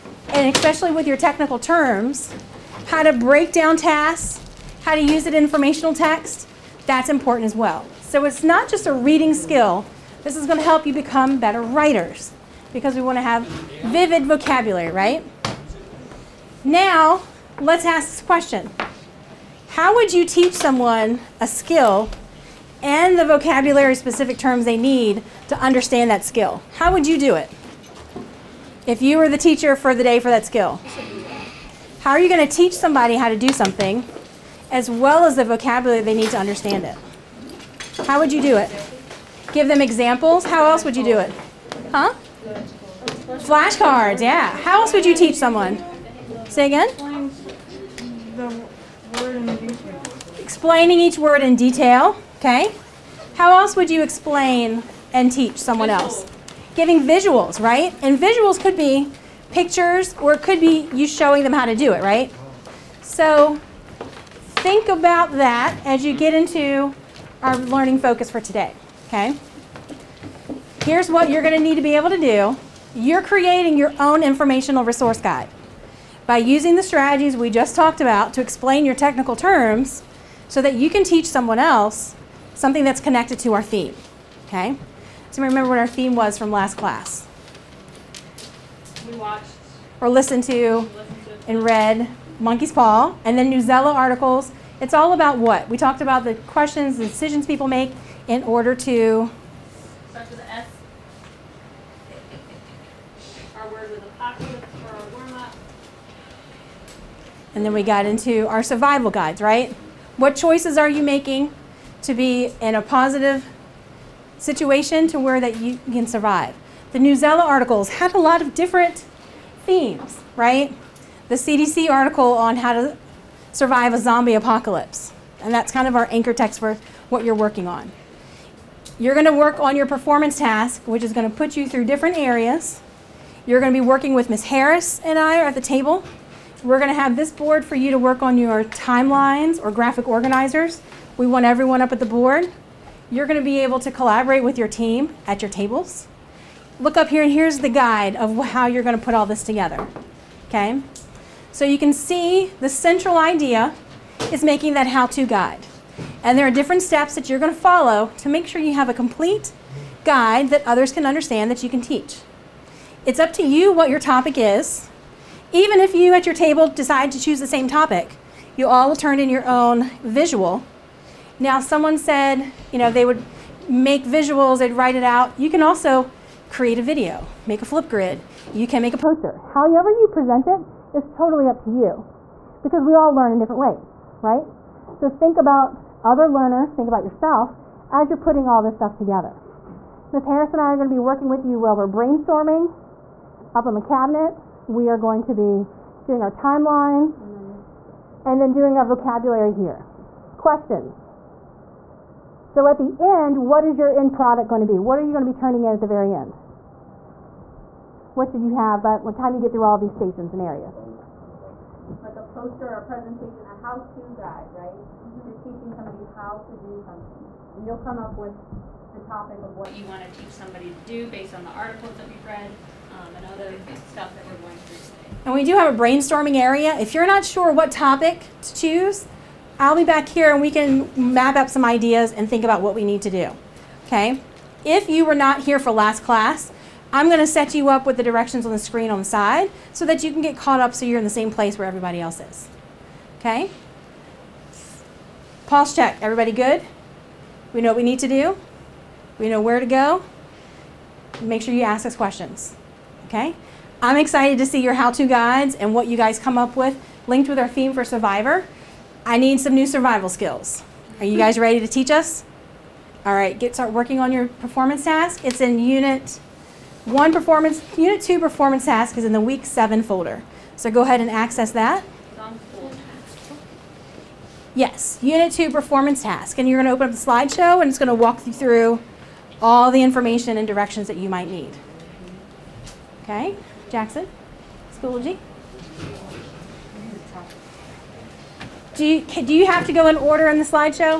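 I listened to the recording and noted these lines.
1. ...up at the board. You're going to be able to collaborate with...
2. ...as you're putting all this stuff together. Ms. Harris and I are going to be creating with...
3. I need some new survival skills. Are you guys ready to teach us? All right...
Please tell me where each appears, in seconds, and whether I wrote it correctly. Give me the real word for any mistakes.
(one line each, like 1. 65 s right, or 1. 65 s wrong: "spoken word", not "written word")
1. 141 s right
2. 187 s wrong: "working", not "creating"
3. 259 s right.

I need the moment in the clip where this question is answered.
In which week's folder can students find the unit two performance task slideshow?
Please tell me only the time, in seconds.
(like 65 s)
269 s.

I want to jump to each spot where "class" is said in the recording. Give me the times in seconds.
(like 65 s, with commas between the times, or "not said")
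86 s, 236 s.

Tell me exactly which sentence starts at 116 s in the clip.
the Newsela articles had a lot of different themes, right?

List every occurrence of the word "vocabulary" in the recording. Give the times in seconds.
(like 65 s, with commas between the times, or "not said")
14 s, 23 s, 35 s, 198 s.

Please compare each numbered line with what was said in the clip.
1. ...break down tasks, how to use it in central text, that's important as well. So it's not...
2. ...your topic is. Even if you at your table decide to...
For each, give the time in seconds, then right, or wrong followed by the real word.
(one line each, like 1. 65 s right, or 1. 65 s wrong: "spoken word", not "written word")
1. 3 s wrong: "informational", not "central"
2. 163 s right.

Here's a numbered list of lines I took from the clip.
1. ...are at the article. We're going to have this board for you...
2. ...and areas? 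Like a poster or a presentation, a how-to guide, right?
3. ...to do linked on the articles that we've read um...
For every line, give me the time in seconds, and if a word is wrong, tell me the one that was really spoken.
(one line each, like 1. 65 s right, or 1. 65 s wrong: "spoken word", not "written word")
1. 135 s wrong: "table", not "article"
2. 210 s right
3. 220 s wrong: "based", not "linked".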